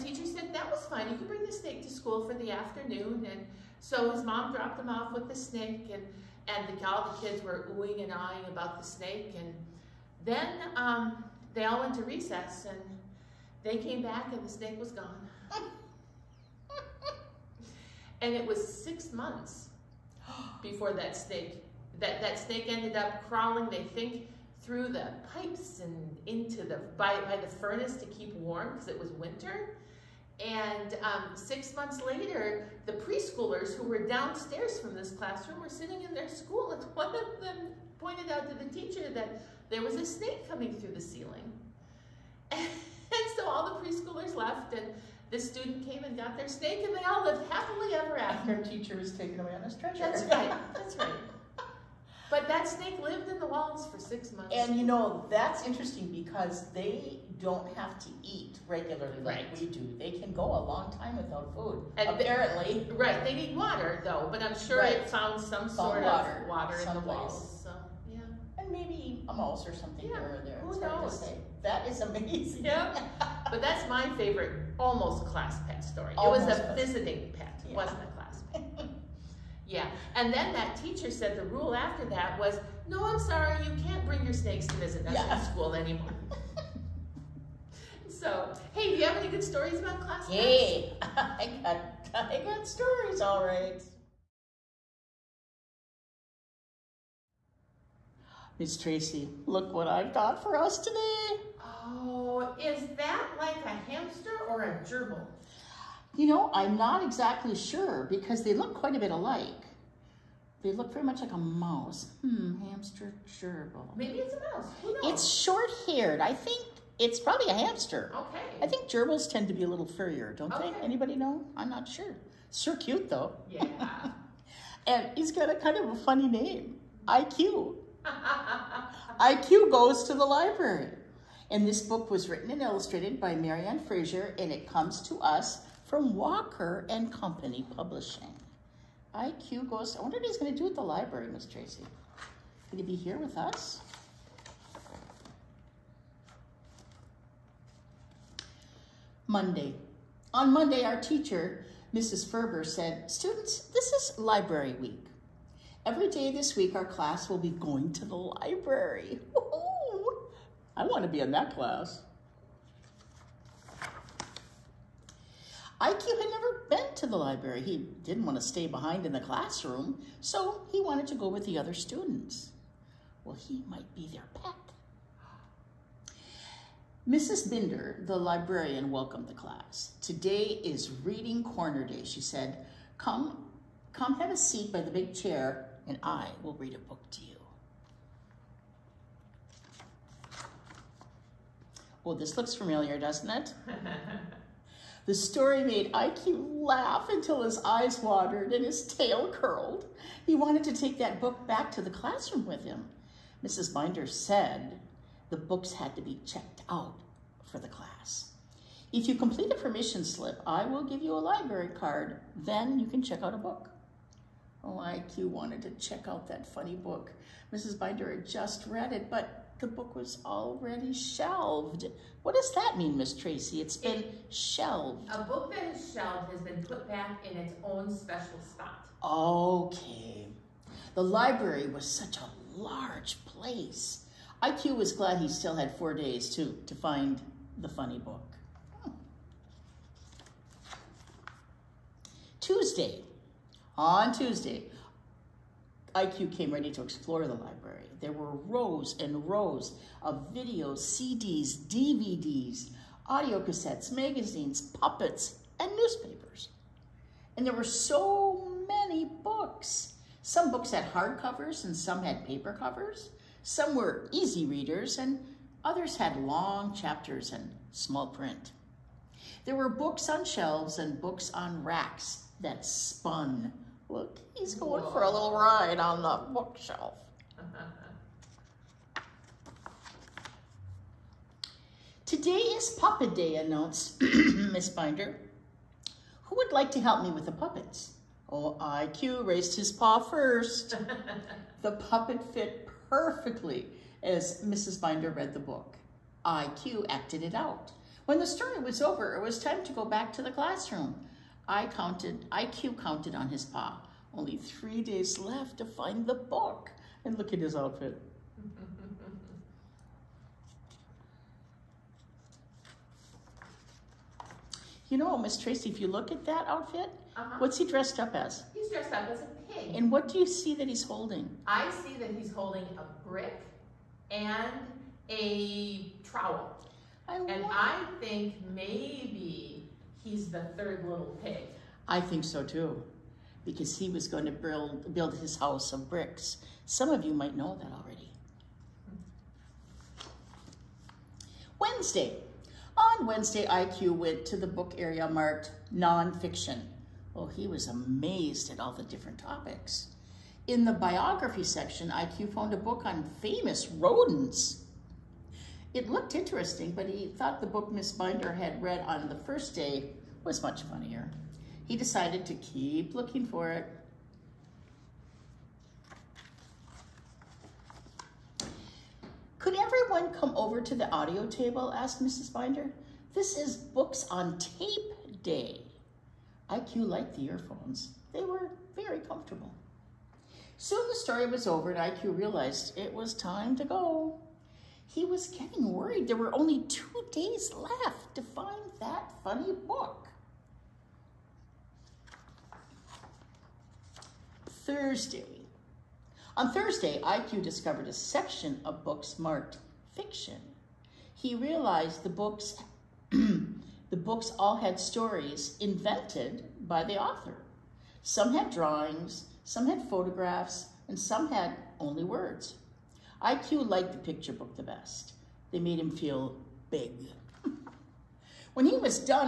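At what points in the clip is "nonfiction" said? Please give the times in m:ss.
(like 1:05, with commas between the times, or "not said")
5:45.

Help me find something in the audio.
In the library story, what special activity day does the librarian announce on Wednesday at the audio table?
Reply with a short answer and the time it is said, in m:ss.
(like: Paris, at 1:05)
Books on Tape Day, at 6:13.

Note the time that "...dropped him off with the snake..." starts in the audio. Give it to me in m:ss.
0:04.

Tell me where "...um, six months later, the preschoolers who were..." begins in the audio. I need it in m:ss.
0:31.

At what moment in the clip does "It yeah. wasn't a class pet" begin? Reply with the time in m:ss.
1:17.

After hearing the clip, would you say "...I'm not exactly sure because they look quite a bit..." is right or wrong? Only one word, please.
right.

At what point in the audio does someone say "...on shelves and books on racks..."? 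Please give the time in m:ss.
4:30.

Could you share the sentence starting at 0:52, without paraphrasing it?
But that snake lived in the walls for six months.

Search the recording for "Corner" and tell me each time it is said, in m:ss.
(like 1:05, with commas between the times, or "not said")
3:01.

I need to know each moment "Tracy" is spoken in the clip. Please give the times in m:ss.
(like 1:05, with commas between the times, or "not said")
1:38, 2:21, 3:43, 5:15.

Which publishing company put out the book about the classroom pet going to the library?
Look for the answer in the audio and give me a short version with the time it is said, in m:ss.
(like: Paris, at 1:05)
Walker and Company, at 2:16.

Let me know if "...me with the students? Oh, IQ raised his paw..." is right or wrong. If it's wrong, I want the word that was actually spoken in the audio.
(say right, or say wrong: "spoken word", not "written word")
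wrong: "puppets", not "students".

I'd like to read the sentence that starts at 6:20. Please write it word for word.
Soon the story was over and IQ realized it was time to go.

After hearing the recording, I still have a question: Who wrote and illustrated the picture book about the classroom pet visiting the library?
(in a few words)
Mary Ann Fraser.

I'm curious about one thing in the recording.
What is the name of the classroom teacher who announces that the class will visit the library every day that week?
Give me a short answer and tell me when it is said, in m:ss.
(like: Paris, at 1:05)
Mrs. Ferber, at 2:31.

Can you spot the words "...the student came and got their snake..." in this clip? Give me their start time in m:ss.
0:45.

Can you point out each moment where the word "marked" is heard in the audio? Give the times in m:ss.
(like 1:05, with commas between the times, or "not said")
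5:45, 6:39.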